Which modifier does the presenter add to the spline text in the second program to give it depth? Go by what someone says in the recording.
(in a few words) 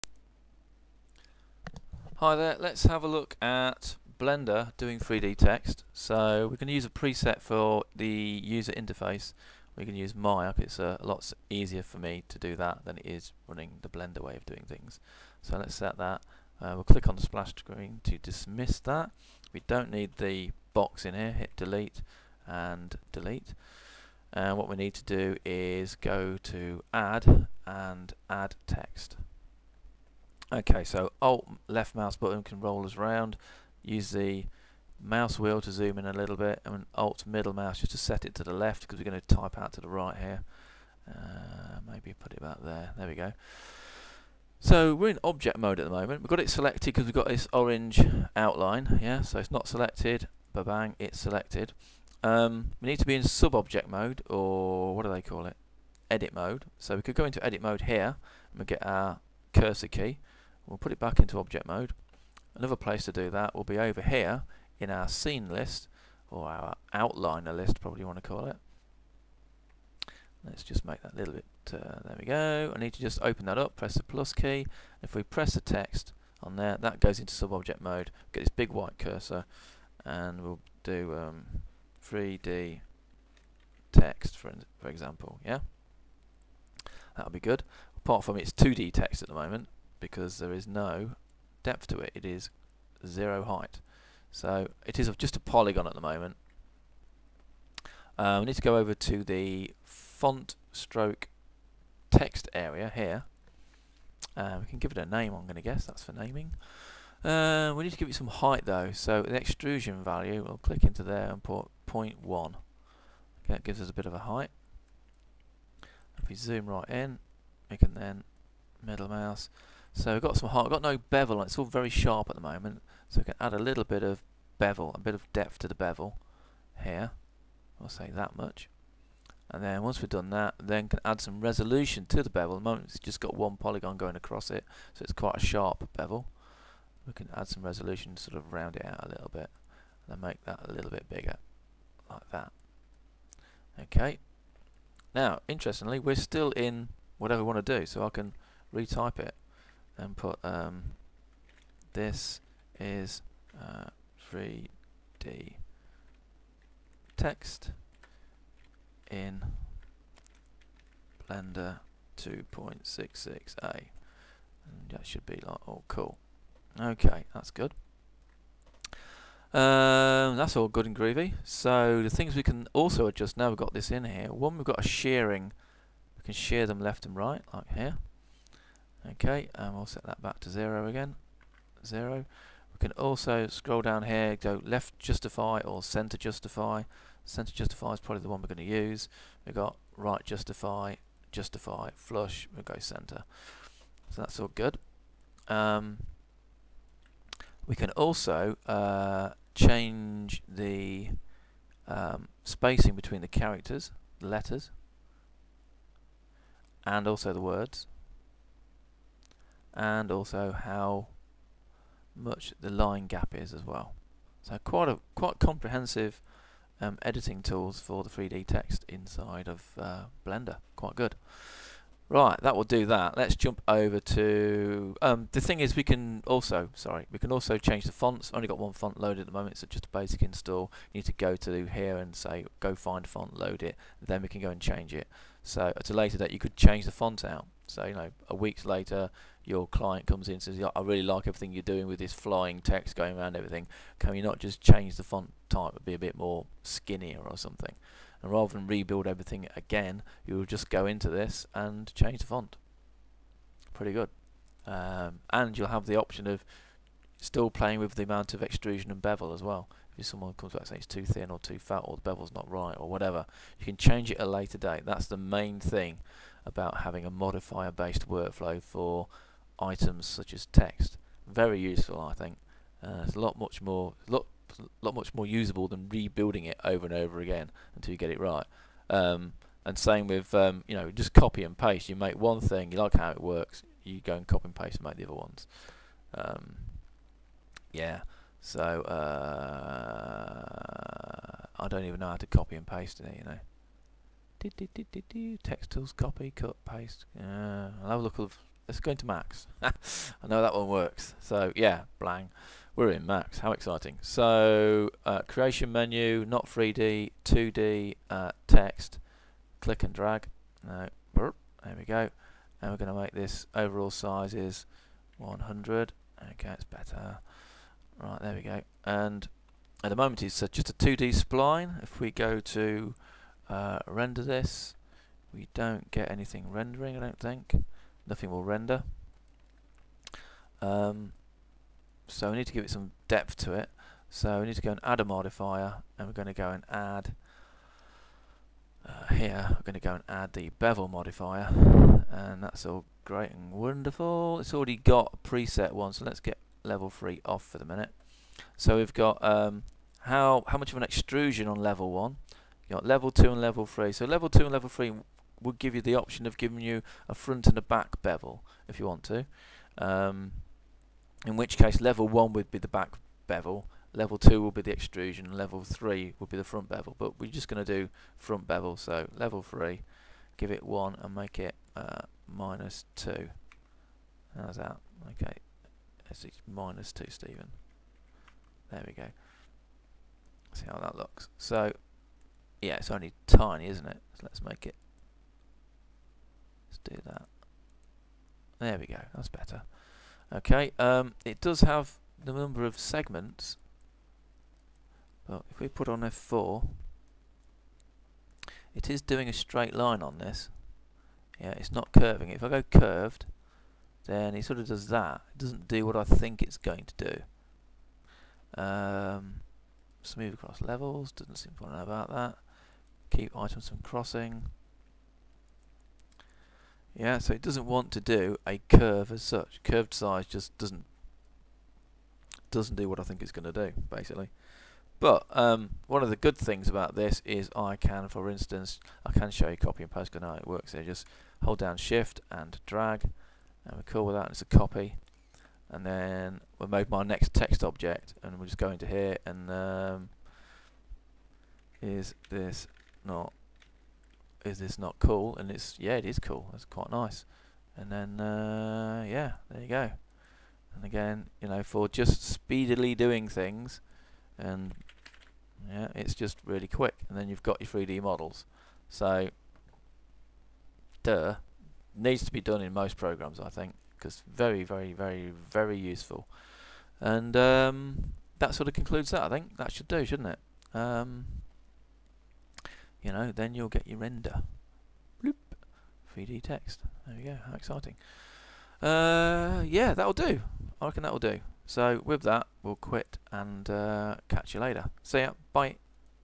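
bevel modifier.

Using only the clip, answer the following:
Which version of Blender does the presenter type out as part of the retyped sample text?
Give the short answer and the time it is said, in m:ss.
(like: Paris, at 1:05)
2.66a, at 2:42.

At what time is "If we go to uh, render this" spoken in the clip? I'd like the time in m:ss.
5:21.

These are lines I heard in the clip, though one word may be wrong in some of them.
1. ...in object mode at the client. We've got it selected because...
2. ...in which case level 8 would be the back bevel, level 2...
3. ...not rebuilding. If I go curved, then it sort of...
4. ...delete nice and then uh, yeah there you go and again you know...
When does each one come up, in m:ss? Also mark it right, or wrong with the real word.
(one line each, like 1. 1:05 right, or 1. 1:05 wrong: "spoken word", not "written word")
1. 0:45 wrong: "moment", not "client"
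2. 6:01 wrong: "1", not "8"
3. 6:41 wrong: "curving", not "rebuilding"
4. 7:26 wrong: "quite", not "delete".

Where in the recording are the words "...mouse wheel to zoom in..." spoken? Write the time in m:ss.
0:35.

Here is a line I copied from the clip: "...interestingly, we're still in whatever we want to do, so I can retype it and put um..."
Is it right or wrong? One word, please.
right.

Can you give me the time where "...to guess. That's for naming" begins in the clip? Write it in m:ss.
1:45.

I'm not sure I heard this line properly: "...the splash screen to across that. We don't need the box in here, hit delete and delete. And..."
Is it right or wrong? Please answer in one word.
wrong.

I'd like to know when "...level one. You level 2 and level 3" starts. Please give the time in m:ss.
5:51.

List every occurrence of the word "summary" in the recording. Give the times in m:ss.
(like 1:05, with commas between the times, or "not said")
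not said.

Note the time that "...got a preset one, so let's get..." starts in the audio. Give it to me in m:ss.
5:44.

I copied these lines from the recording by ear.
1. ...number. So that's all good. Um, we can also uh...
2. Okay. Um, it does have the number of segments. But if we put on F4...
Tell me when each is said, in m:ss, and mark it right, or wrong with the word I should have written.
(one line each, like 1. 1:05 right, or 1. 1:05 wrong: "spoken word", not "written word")
1. 3:12 wrong: "center", not "number"
2. 6:30 right.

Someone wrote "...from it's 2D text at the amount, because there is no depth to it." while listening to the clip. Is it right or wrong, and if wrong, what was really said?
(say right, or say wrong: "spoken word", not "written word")
wrong: "moment", not "amount".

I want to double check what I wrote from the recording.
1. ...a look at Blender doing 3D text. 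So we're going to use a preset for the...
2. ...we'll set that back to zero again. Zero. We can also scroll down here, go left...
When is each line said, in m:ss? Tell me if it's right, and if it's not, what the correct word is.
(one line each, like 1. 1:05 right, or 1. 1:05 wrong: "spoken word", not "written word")
1. 0:03 right
2. 2:59 right.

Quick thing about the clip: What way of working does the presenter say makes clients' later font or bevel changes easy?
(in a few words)
modifier based workflow.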